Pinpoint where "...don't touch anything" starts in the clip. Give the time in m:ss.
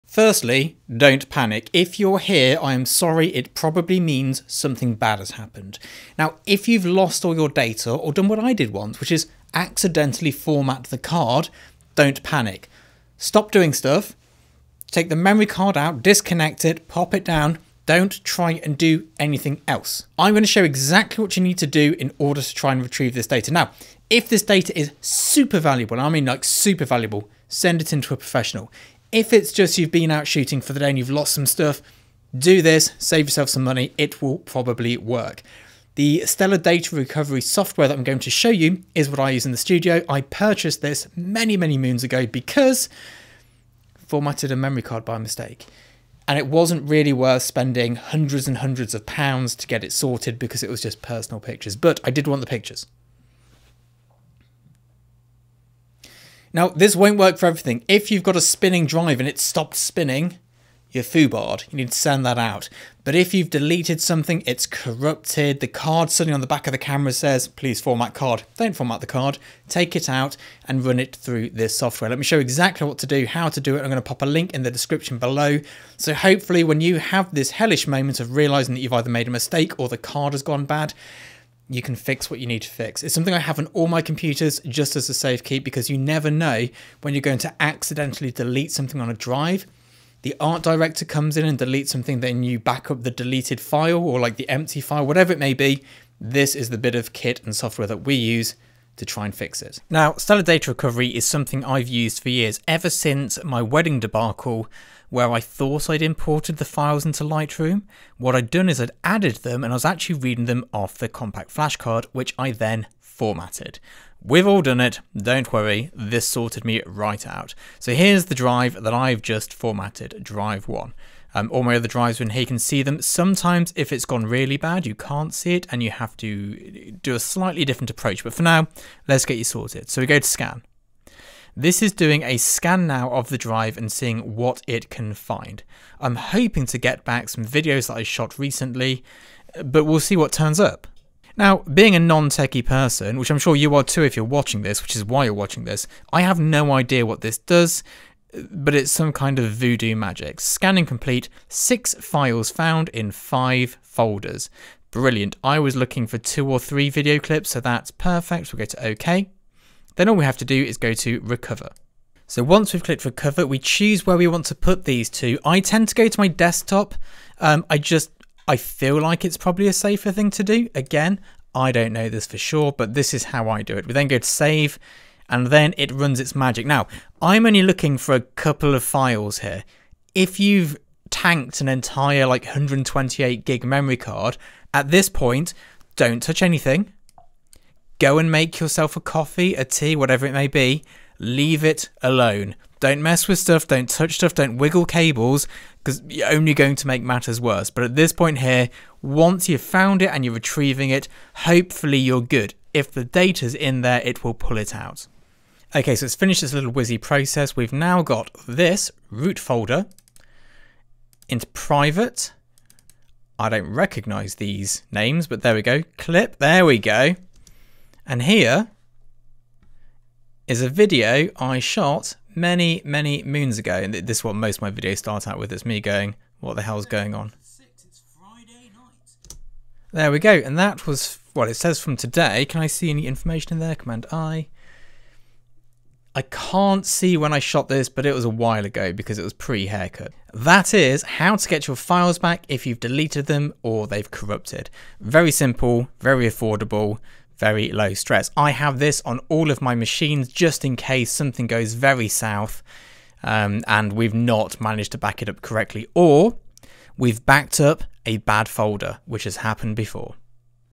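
3:05.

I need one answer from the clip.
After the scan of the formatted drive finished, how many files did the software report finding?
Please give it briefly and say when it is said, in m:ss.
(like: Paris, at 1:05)
6, at 2:31.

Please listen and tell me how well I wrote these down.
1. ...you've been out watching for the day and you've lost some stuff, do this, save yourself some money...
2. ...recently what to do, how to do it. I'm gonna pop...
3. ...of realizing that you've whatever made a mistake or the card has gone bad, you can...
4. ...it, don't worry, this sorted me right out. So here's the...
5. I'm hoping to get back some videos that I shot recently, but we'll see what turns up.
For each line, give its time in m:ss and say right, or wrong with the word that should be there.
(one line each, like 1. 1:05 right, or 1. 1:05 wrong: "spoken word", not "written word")
1. 0:29 wrong: "shooting", not "watching"
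2. 1:12 wrong: "exactly", not "recently"
3. 1:18 wrong: "either", not "whatever"
4. 1:54 right
5. 2:15 right.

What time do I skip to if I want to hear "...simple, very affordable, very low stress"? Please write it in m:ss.
4:05.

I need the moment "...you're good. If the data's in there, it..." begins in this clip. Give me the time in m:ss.
3:21.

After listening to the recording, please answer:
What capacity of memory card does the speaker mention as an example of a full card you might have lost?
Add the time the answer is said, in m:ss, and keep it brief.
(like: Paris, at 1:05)
128 gig, at 3:02.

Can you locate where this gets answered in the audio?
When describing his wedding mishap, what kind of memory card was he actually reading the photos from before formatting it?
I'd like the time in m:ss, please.
1:51.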